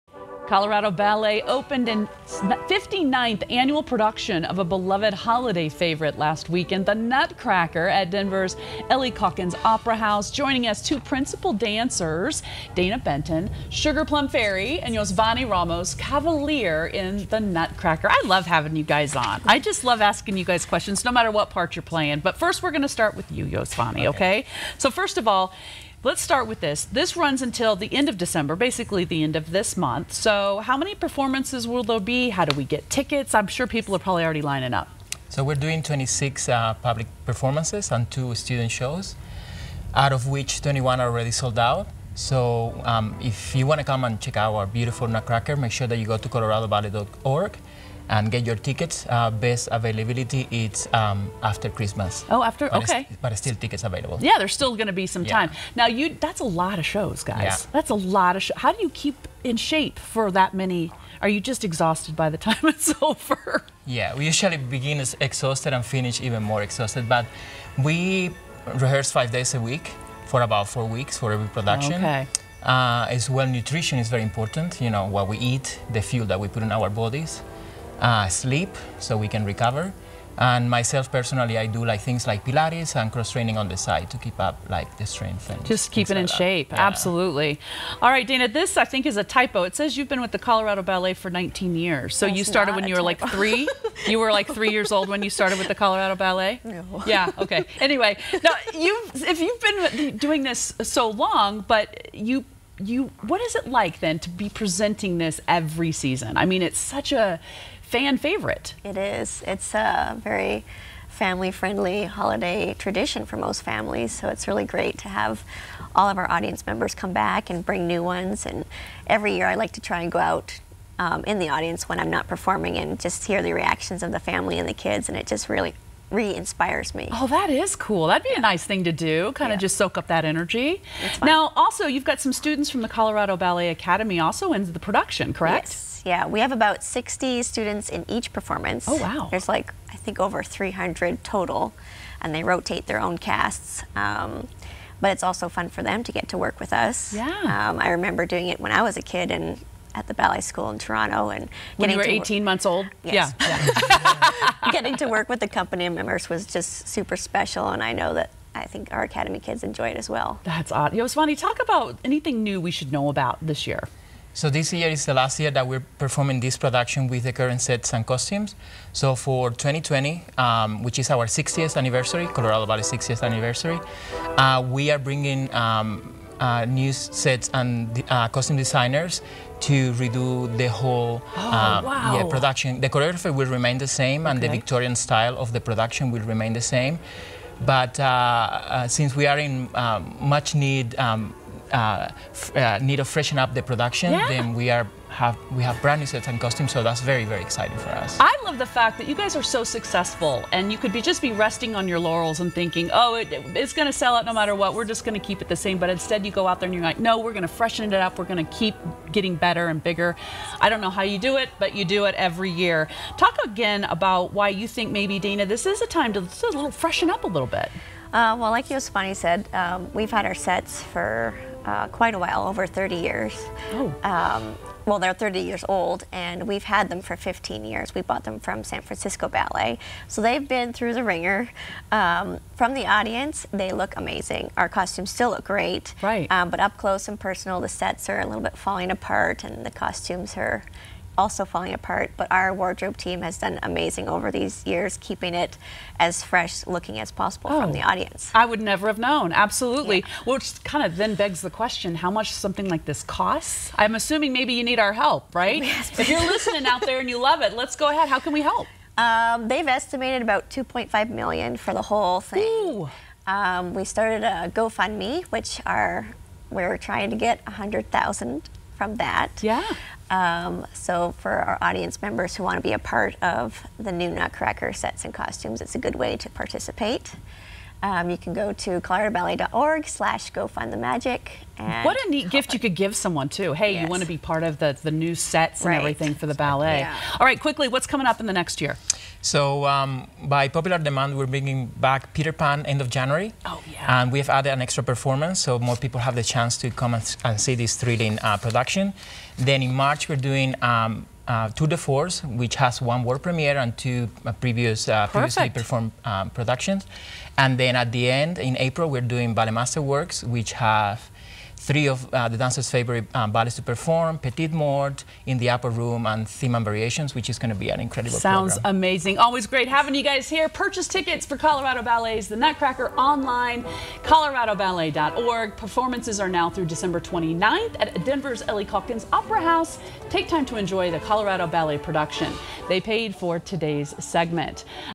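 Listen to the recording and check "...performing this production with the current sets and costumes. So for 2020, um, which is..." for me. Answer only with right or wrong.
right.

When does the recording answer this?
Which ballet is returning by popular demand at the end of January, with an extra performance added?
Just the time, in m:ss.
4:52.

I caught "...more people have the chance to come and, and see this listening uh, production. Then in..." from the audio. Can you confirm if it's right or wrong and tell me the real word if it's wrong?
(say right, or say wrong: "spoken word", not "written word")
wrong: "thrilling", not "listening".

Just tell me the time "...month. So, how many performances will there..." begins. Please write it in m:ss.
0:29.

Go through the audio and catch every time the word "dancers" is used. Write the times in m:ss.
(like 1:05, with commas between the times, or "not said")
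0:11, 5:12.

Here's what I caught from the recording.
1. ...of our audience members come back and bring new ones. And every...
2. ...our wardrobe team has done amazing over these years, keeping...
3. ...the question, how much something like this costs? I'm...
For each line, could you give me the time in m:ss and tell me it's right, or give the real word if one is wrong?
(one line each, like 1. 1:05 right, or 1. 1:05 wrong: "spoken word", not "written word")
1. 1:56 right
2. 4:02 right
3. 4:11 right.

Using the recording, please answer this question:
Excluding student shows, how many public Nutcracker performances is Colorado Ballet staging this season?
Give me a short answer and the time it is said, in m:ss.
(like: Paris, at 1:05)
26, at 0:35.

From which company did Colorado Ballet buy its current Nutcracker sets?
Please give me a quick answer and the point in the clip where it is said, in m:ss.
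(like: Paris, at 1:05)
San Francisco Ballet, at 3:48.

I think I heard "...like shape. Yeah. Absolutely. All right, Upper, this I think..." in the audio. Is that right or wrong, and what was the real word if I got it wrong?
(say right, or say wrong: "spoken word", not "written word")
wrong: "Dana", not "Upper".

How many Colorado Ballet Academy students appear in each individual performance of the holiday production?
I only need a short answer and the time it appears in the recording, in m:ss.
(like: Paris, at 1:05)
60, at 2:16.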